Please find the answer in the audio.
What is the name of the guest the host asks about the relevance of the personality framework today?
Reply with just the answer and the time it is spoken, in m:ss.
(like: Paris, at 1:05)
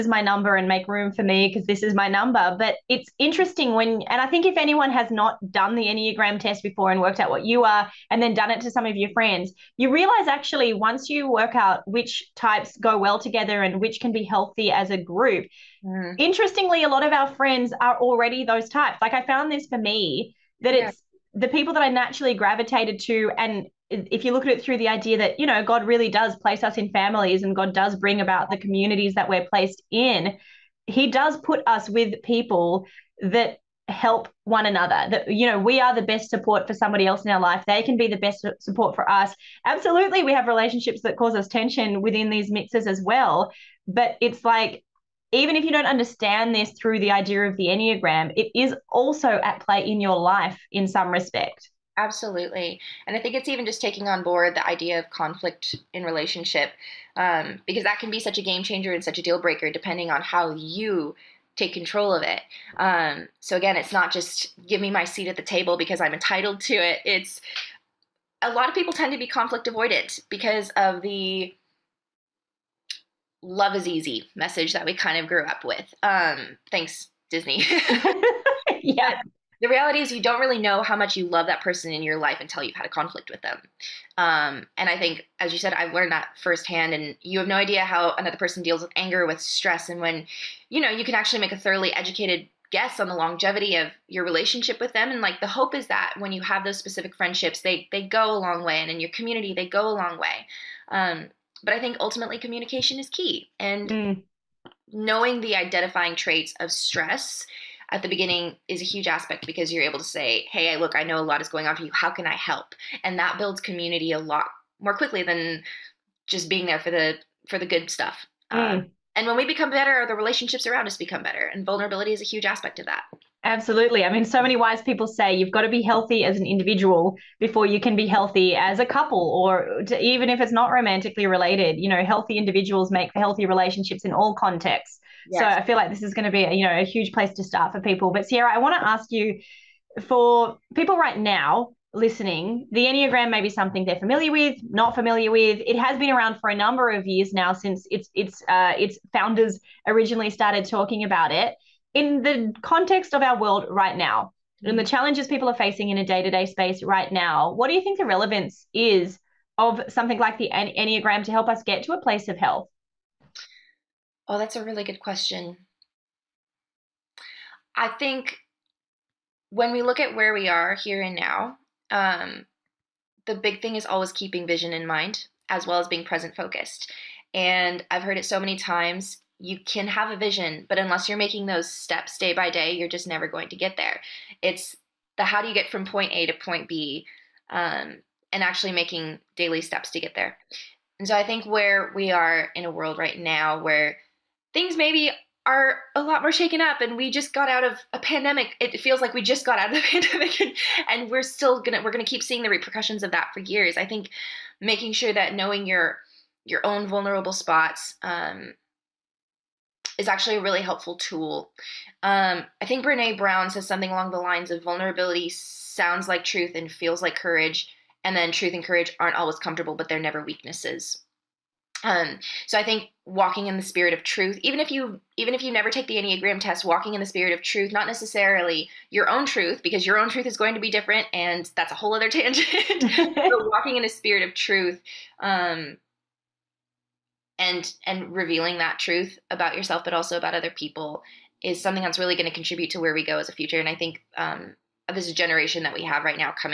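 Sierra, at 2:18.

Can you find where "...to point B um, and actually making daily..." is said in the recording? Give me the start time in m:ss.
3:06.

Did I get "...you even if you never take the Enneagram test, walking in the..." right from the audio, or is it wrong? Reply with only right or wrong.
right.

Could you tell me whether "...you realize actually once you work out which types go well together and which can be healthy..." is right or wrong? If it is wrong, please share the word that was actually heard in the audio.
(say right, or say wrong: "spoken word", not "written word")
right.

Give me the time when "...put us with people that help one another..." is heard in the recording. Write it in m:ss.
0:31.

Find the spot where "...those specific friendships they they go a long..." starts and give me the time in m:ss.
1:36.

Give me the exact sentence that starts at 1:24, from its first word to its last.
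Um, and I think, as you said, I've learned that firsthand.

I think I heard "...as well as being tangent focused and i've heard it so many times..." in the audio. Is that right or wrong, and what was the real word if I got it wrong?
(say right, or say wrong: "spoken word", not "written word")
wrong: "present", not "tangent".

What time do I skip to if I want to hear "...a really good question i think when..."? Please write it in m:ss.
2:44.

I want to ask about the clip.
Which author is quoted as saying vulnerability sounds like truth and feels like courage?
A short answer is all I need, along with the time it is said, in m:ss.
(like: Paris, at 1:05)
Brene Brown, at 3:32.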